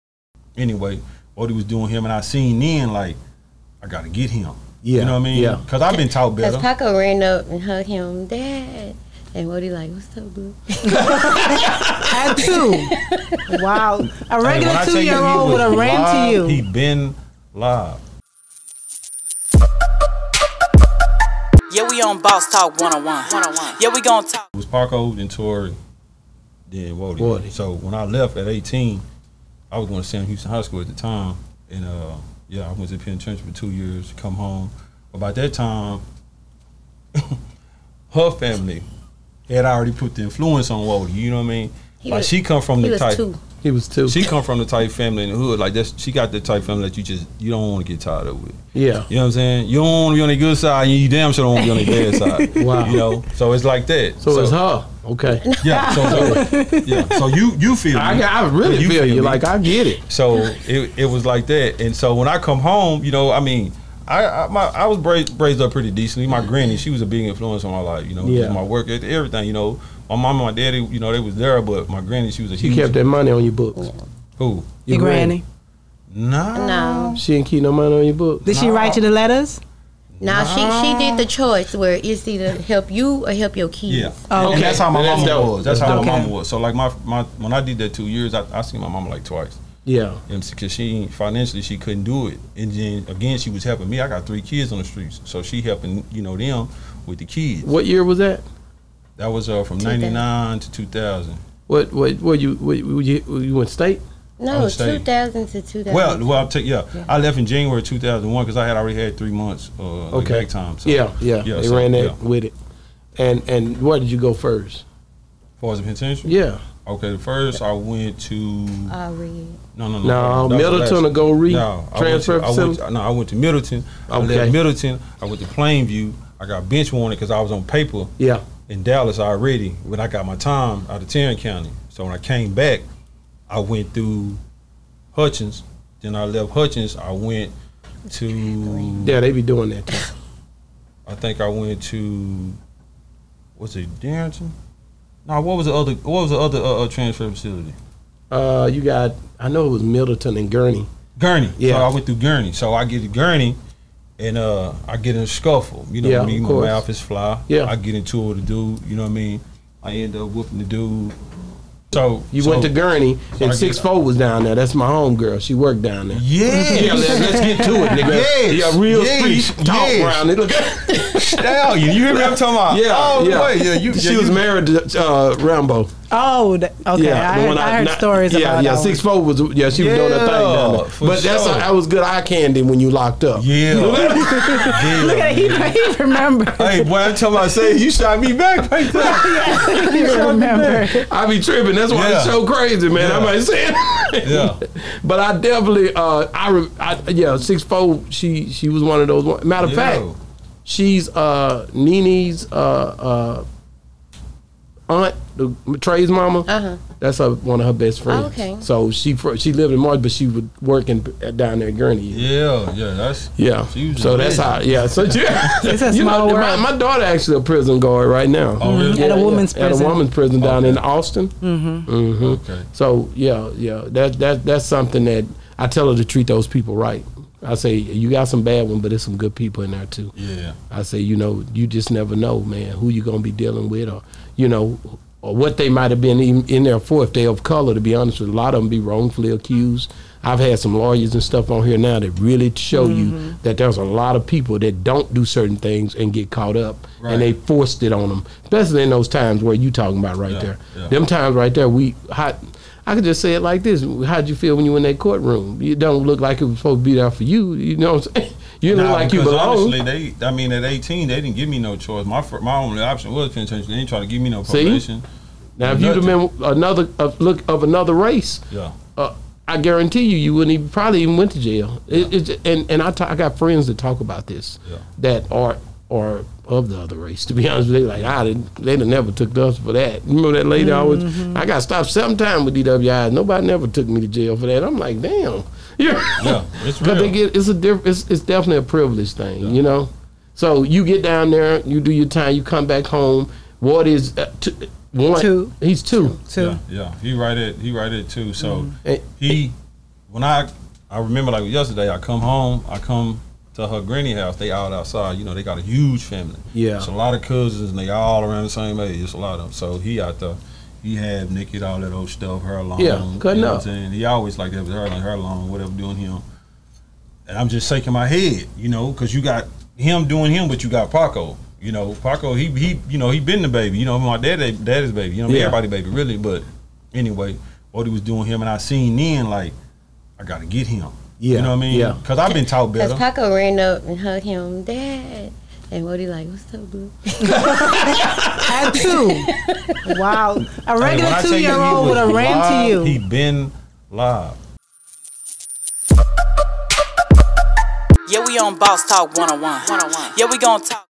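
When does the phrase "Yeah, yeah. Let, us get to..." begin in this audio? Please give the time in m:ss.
2:46.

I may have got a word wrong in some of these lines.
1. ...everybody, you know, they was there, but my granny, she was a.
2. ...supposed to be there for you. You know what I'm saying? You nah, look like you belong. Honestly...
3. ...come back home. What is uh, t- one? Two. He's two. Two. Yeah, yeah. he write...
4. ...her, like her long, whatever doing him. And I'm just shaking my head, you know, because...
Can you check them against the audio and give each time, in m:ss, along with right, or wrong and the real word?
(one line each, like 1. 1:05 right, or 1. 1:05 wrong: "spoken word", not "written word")
1. 1:10 wrong: "daddy", not "everybody"
2. 4:16 right
3. 4:52 right
4. 5:14 right.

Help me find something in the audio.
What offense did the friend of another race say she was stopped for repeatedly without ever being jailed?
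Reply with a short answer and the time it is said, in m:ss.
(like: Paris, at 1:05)
DWI, at 4:42.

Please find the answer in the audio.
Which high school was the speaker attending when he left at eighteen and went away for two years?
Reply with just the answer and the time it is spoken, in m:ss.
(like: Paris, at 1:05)
Sam Houston High School, at 0:30.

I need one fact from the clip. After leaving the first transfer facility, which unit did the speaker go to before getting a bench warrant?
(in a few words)
Plainview.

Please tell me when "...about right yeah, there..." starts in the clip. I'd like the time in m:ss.
4:10.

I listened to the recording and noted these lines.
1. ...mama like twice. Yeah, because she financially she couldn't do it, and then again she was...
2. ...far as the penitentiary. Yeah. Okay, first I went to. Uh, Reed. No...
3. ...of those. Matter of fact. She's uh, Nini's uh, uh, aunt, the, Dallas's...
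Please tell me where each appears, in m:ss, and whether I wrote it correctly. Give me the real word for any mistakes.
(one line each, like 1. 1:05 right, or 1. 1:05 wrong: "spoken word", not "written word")
1. 1:28 right
2. 1:55 right
3. 3:18 wrong: "Trey", not "Dallas".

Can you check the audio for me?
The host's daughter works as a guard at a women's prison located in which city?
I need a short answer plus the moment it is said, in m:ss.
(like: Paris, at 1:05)
Austin, at 3:40.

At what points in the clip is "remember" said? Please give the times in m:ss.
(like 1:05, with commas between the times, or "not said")
3:06, 4:40, 5:00.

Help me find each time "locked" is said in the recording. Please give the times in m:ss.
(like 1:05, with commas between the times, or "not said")
3:02.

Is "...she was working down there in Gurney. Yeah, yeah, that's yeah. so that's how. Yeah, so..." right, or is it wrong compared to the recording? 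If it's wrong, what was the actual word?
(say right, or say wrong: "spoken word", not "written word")
right.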